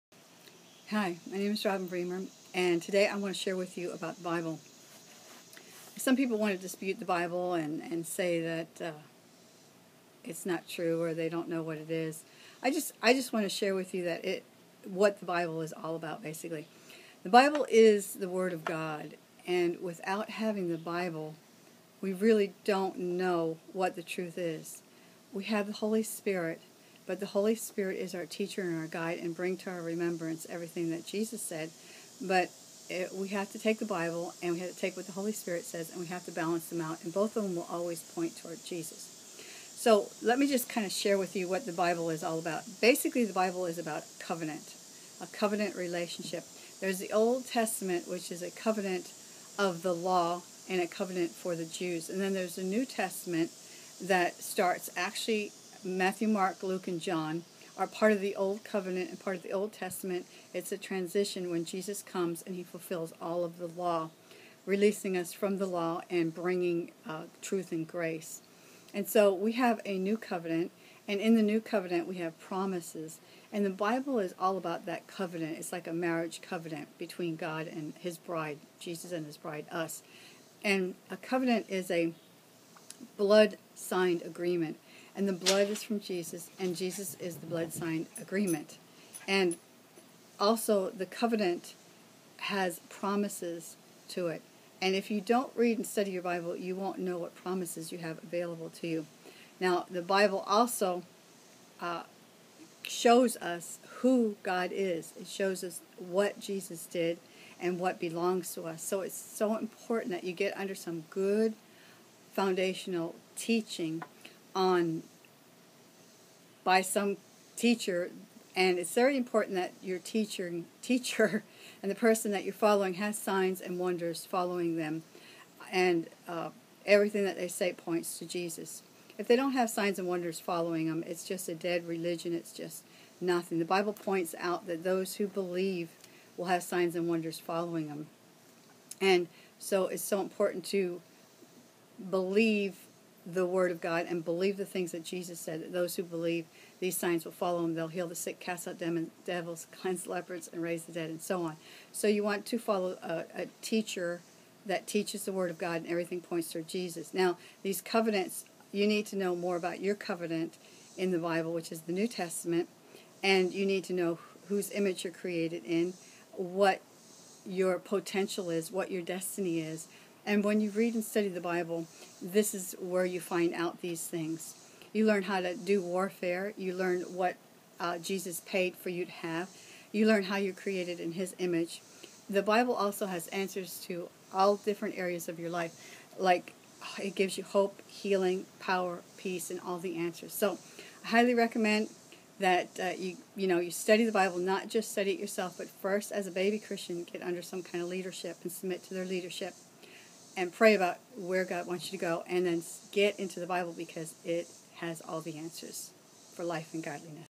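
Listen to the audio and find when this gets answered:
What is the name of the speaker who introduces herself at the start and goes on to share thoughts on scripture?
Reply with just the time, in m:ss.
0:01.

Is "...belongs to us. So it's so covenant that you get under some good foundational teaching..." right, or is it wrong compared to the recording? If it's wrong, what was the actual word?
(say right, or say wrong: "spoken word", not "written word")
wrong: "important", not "covenant".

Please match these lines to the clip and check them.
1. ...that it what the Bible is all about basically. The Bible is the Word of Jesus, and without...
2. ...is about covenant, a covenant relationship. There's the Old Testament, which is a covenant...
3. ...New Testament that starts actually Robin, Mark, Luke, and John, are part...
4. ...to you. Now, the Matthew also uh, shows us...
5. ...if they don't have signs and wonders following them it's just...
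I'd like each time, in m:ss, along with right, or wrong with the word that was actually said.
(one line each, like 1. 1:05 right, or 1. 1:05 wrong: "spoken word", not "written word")
1. 0:14 wrong: "God", not "Jesus"
2. 0:43 right
3. 0:52 wrong: "Matthew", not "Robin"
4. 1:38 wrong: "Bible", not "Matthew"
5. 2:09 right.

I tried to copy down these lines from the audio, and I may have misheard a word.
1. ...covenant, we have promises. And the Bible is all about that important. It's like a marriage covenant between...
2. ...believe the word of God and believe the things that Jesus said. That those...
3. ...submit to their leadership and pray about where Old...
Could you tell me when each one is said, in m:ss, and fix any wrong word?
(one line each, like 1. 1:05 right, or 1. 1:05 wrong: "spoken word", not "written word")
1. 1:11 wrong: "covenant", not "important"
2. 2:22 right
3. 3:18 wrong: "God", not "Old".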